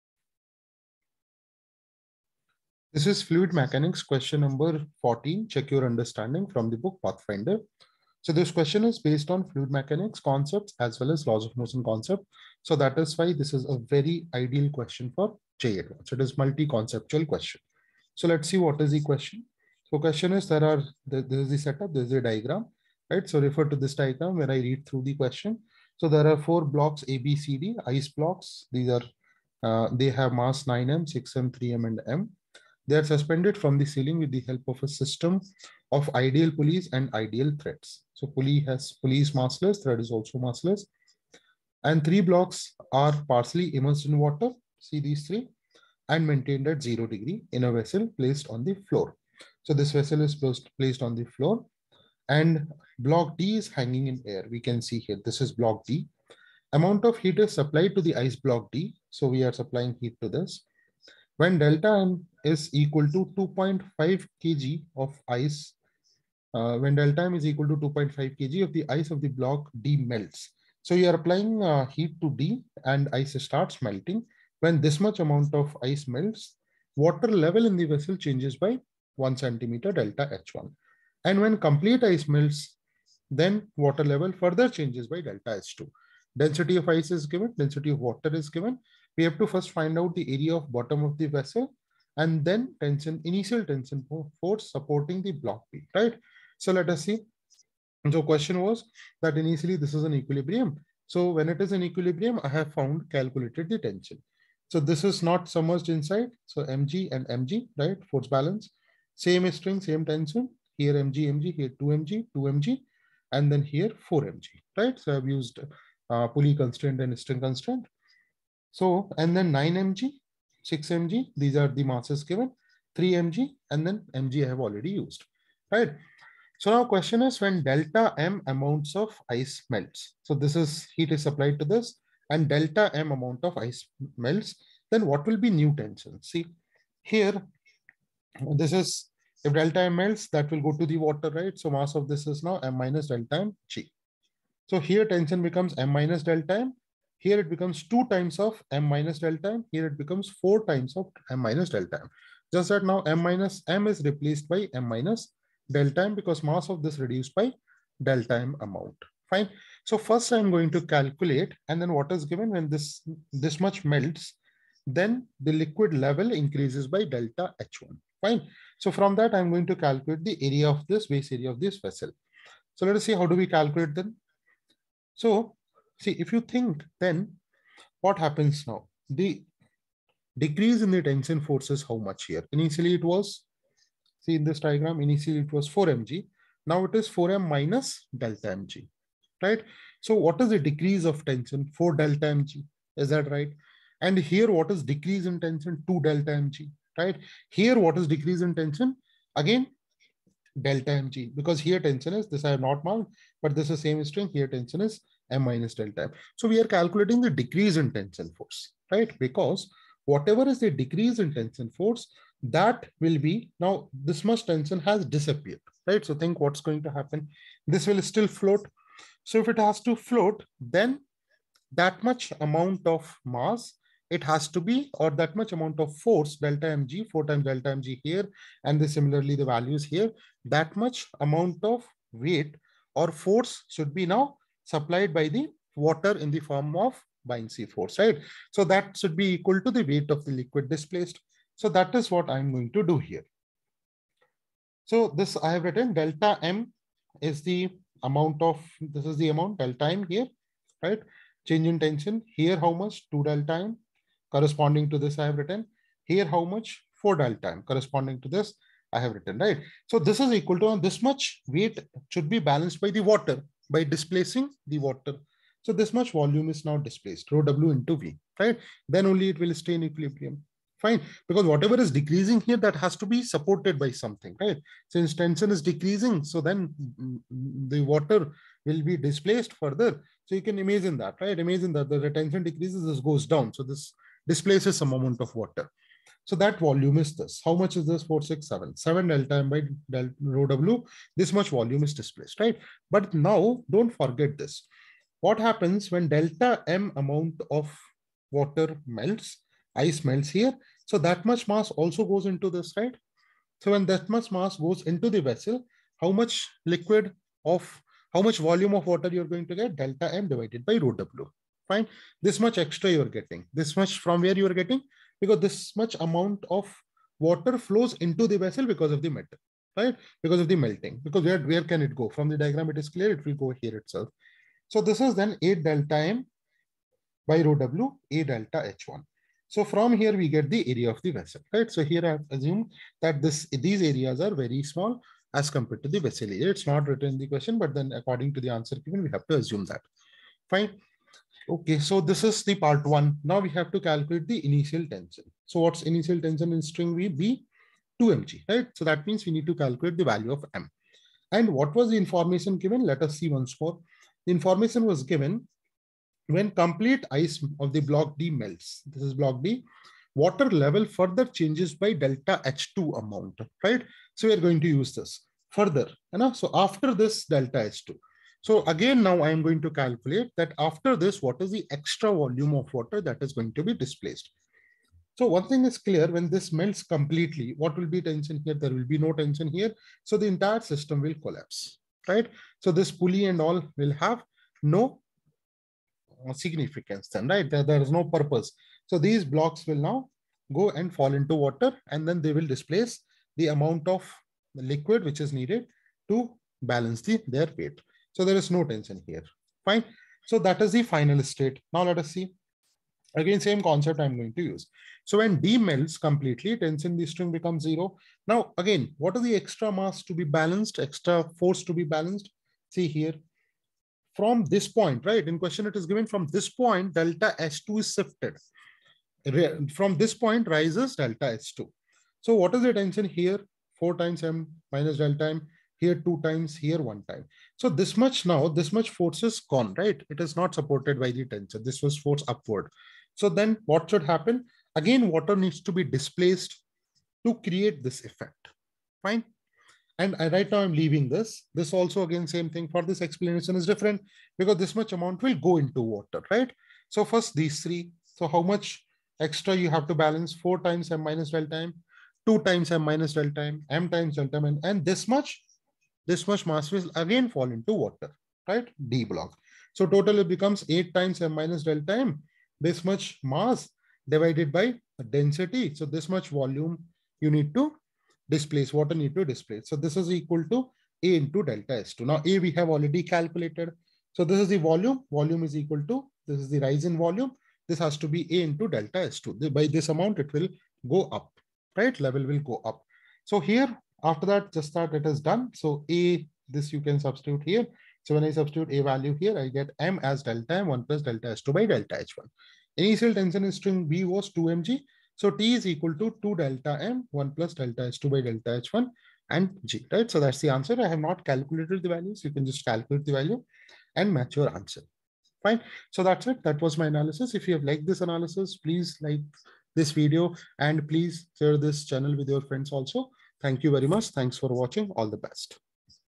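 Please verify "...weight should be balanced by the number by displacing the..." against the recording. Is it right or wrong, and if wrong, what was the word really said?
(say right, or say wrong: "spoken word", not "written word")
wrong: "water", not "number".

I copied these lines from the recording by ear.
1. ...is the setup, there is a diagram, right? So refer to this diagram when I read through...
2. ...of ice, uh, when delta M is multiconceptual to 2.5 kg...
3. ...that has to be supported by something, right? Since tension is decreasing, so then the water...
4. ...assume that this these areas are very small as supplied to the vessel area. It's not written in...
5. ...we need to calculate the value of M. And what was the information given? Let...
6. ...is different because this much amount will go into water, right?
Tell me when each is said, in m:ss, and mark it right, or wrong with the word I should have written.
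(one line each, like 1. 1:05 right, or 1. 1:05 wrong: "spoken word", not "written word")
1. 0:21 right
2. 1:04 wrong: "equal", not "multiconceptual"
3. 4:32 right
4. 5:32 wrong: "compared", not "supplied"
5. 5:49 right
6. 7:23 right.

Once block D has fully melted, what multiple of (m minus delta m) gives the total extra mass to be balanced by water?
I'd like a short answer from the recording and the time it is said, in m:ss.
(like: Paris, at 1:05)
8, at 7:40.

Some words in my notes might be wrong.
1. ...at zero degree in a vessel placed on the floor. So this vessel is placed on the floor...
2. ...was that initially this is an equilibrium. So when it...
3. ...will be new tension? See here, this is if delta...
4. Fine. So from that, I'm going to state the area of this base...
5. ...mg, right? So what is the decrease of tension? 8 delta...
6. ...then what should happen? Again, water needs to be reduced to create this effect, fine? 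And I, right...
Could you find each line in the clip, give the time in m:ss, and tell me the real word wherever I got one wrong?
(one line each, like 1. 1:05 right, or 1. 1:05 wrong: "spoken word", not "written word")
1. 0:46 right
2. 1:38 right
3. 2:15 right
4. 2:48 wrong: "calculate", not "state"
5. 3:08 wrong: "4", not "8"
6. 7:13 wrong: "displaced", not "reduced".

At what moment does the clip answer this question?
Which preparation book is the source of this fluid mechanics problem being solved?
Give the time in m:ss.
0:07.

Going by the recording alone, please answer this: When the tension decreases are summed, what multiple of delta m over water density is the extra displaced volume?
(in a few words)
7.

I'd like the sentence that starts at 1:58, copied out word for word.
So, and then 9 mg, 6 mg, these are the masses given, 3 mg, and then mg I have already used, right?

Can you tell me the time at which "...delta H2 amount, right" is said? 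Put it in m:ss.
6:01.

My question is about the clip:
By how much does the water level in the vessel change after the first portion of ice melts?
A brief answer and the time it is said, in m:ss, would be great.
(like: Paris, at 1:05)
1 centimeter, at 1:19.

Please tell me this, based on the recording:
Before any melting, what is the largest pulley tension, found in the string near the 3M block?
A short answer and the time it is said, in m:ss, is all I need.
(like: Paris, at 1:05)
4mg, at 1:54.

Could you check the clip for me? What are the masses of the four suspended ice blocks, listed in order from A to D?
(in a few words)
9M, 6M, 3M and M.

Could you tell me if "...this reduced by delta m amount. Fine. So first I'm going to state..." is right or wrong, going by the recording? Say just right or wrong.
wrong.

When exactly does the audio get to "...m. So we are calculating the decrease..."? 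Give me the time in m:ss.
3:26.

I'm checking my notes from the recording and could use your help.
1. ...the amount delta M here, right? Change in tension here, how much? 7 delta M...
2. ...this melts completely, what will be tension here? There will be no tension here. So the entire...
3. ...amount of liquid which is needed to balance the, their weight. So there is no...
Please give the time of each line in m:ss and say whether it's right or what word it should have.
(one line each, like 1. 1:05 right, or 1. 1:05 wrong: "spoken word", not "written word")
1. 4:09 wrong: "2", not "7"
2. 6:16 right
3. 6:33 right.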